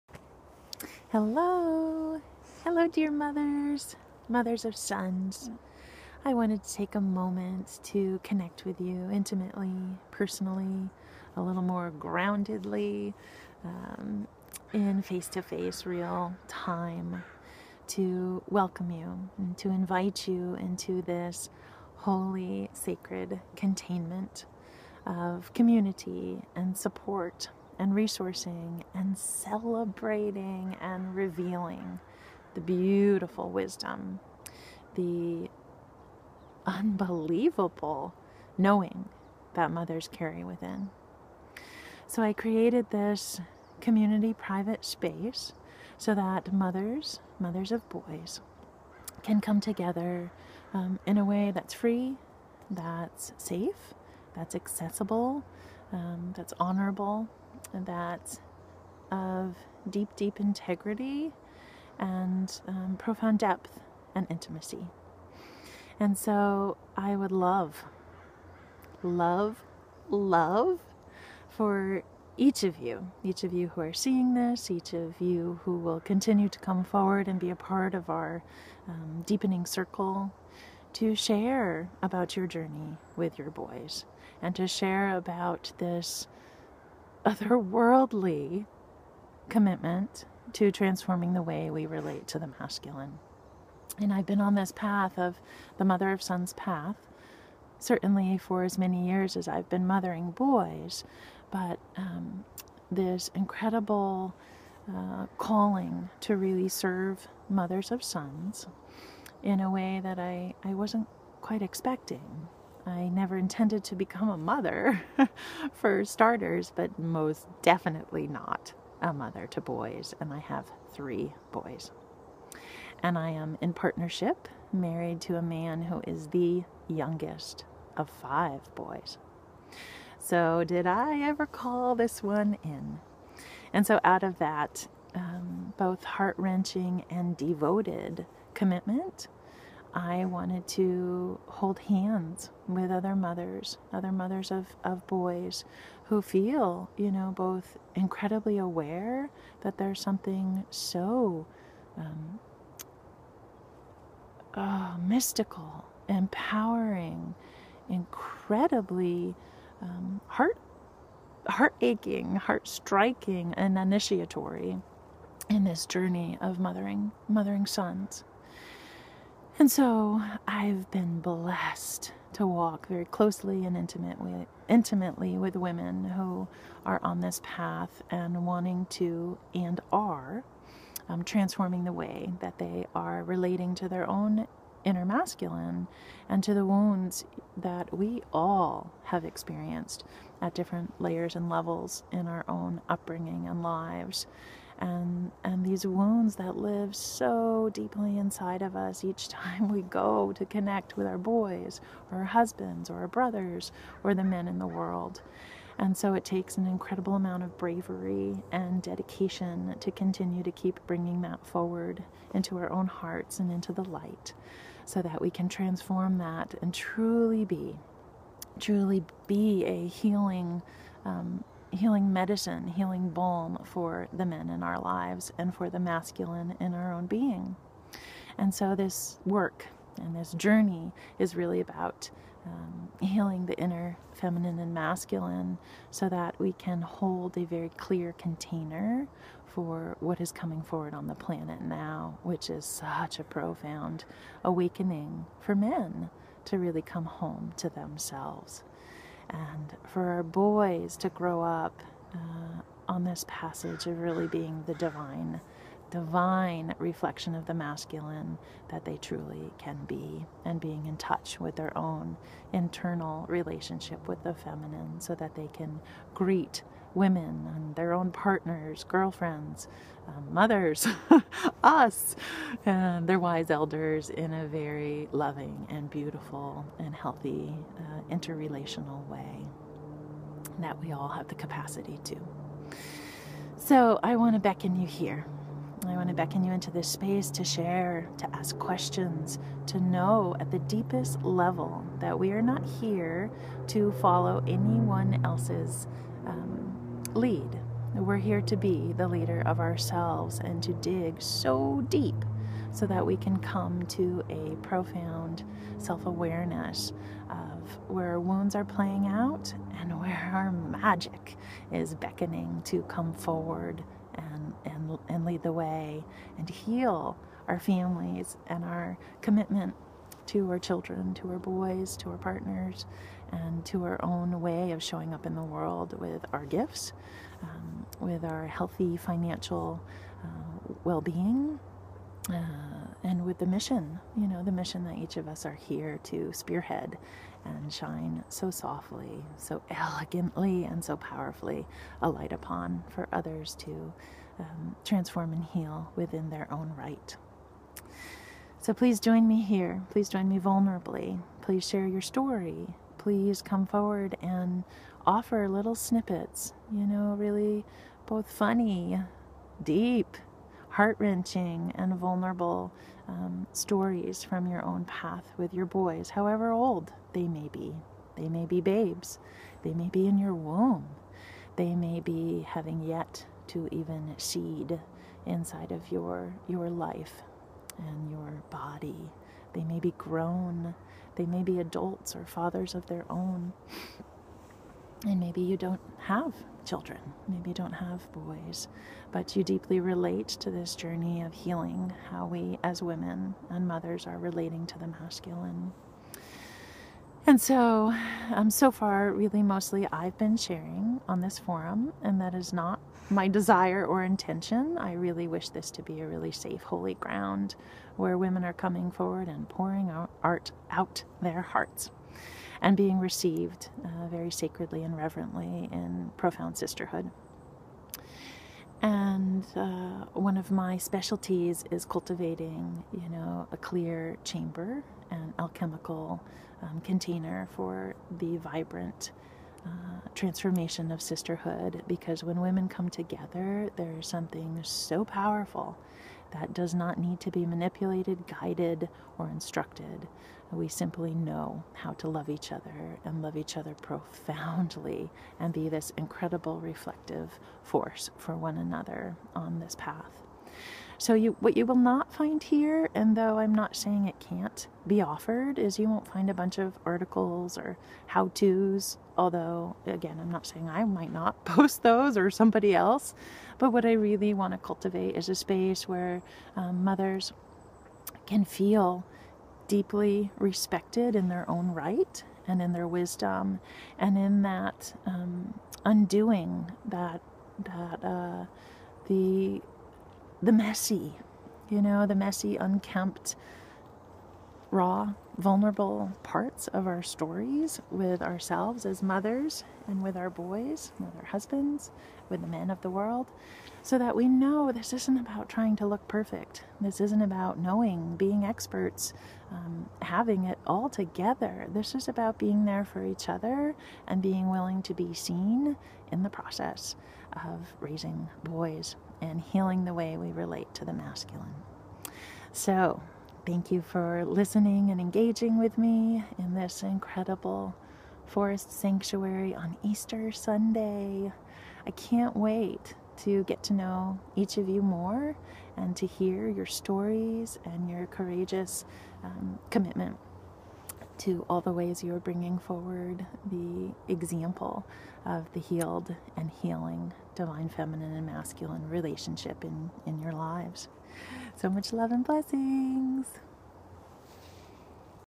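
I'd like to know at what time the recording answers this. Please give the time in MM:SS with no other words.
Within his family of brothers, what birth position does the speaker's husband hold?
02:06.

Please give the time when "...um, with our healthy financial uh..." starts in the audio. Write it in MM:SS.
05:27.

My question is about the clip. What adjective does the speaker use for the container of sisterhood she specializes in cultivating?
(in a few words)
Alchemical.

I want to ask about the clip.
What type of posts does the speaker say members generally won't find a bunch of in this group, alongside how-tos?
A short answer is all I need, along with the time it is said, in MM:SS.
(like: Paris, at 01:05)
Articles, at 07:36.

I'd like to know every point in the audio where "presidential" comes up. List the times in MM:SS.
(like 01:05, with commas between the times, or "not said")
not said.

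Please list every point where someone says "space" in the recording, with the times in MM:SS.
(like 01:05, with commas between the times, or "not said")
00:44, 04:46, 07:45.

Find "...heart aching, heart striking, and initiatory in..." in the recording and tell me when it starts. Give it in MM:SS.
02:41.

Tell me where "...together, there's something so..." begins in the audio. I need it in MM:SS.
07:12.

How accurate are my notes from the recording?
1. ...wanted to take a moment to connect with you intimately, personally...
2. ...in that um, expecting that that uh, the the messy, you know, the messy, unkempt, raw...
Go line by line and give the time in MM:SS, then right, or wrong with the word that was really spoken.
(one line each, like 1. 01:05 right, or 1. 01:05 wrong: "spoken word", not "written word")
1. 00:06 right
2. 07:54 wrong: "undoing", not "expecting".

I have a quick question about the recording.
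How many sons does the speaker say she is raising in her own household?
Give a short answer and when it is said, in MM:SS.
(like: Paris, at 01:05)
3, at 02:00.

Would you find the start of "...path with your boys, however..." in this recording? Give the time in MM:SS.
06:04.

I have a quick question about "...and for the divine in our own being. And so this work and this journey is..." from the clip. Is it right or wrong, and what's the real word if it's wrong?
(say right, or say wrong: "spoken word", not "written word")
wrong: "masculine", not "divine".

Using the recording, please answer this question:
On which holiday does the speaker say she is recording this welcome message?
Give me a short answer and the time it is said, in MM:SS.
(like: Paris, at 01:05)
Easter Sunday, at 08:39.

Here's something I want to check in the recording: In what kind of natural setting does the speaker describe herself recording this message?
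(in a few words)
Forest sanctuary.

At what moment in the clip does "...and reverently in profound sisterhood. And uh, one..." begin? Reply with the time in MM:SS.
06:54.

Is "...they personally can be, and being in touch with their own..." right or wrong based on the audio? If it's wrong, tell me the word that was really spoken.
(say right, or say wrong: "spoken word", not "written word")
wrong: "truly", not "personally".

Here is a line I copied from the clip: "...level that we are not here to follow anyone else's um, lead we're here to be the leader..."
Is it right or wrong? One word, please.
right.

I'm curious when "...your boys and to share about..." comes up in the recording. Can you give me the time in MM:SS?
01:23.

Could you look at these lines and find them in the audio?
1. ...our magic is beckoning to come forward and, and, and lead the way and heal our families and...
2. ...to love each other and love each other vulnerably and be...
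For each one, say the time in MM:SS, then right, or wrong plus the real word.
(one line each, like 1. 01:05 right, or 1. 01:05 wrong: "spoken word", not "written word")
1. 05:10 right
2. 07:21 wrong: "profoundly", not "vulnerably".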